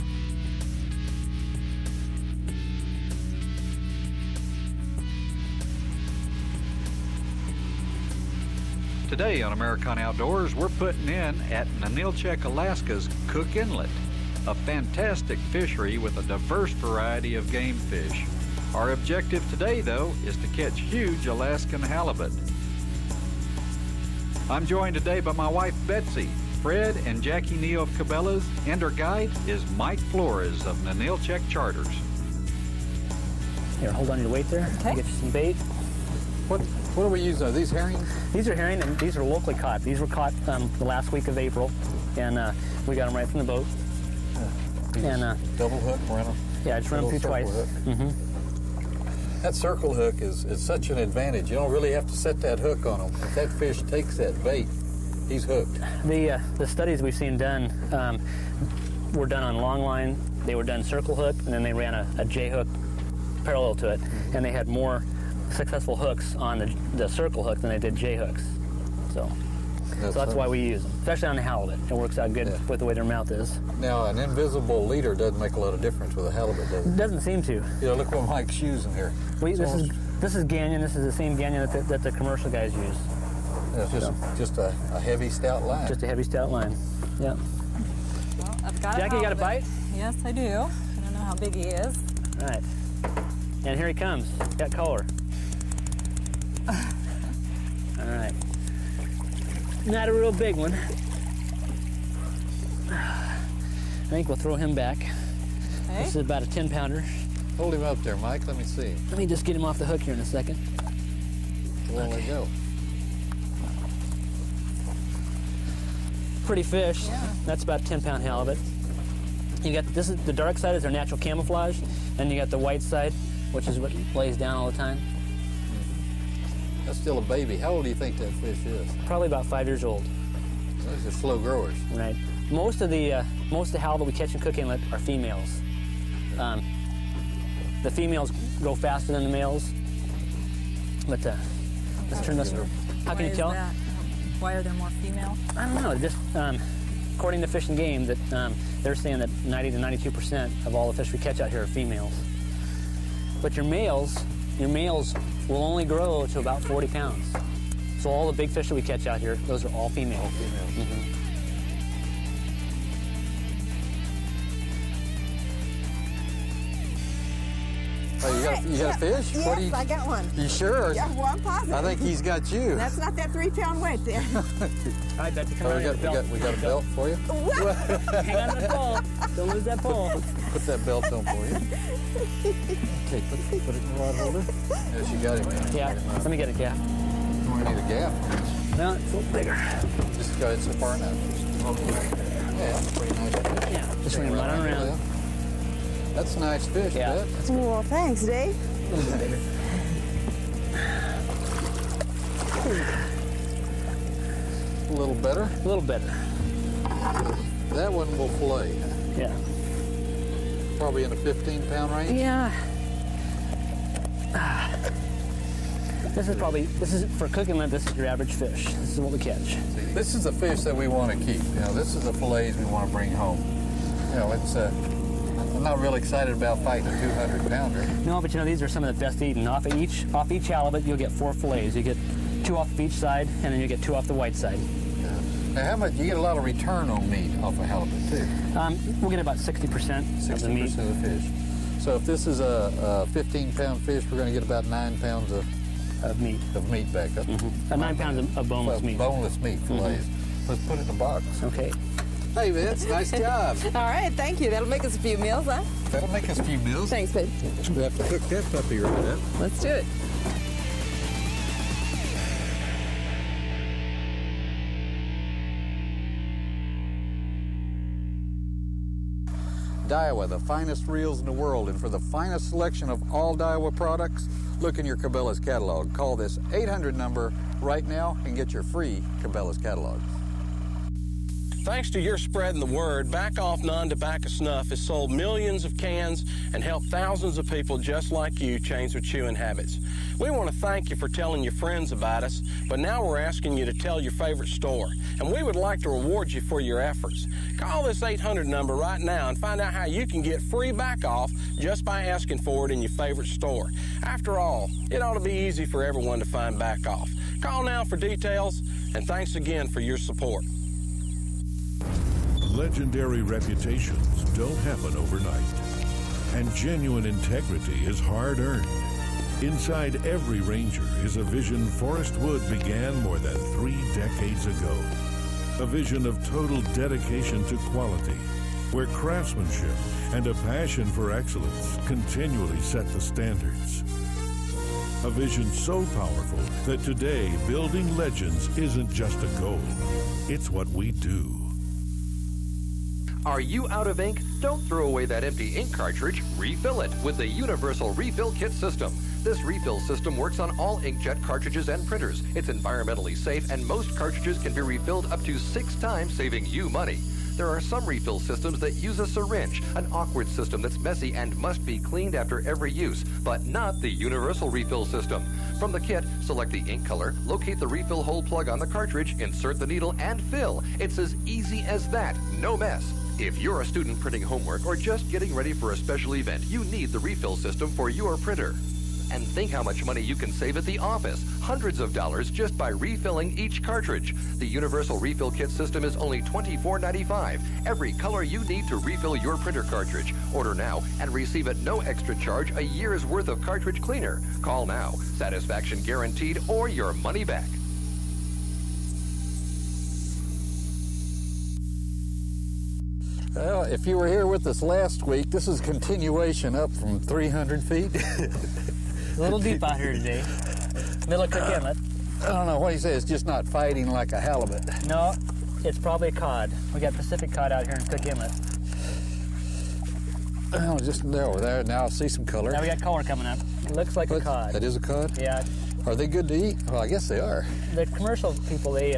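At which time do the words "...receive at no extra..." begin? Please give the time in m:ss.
6:31.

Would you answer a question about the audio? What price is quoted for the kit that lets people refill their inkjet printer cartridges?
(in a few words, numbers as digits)
$24.95.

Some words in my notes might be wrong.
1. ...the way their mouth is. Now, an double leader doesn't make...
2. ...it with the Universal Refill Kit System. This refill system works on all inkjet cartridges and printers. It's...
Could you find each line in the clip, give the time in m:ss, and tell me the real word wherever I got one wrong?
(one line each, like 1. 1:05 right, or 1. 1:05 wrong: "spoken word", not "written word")
1. 1:12 wrong: "invisible", not "double"
2. 5:46 right.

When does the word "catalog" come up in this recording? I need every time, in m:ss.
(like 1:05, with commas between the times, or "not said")
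4:35, 4:39.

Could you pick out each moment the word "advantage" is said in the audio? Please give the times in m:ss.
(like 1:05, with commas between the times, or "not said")
0:50.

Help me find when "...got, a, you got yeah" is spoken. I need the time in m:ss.
2:48.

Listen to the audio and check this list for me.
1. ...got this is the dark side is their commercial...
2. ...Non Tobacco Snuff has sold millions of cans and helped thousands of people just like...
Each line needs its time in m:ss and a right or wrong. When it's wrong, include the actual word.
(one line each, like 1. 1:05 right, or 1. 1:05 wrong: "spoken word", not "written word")
1. 1:59 wrong: "natural", not "commercial"
2. 4:43 right.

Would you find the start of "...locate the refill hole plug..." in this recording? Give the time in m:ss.
6:07.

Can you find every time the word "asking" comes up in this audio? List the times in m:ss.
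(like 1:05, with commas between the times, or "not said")
4:53, 5:02.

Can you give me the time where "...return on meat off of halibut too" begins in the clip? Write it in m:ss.
3:56.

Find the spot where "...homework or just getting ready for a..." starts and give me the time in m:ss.
6:14.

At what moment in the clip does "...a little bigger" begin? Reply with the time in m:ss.
3:09.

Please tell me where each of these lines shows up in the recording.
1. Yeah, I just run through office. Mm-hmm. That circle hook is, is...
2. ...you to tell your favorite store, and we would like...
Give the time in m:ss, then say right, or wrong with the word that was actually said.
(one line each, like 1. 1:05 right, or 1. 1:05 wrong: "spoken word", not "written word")
1. 0:46 wrong: "twice", not "office"
2. 4:53 right.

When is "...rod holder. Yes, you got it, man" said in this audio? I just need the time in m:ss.
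3:04.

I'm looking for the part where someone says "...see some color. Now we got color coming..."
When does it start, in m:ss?
7:01.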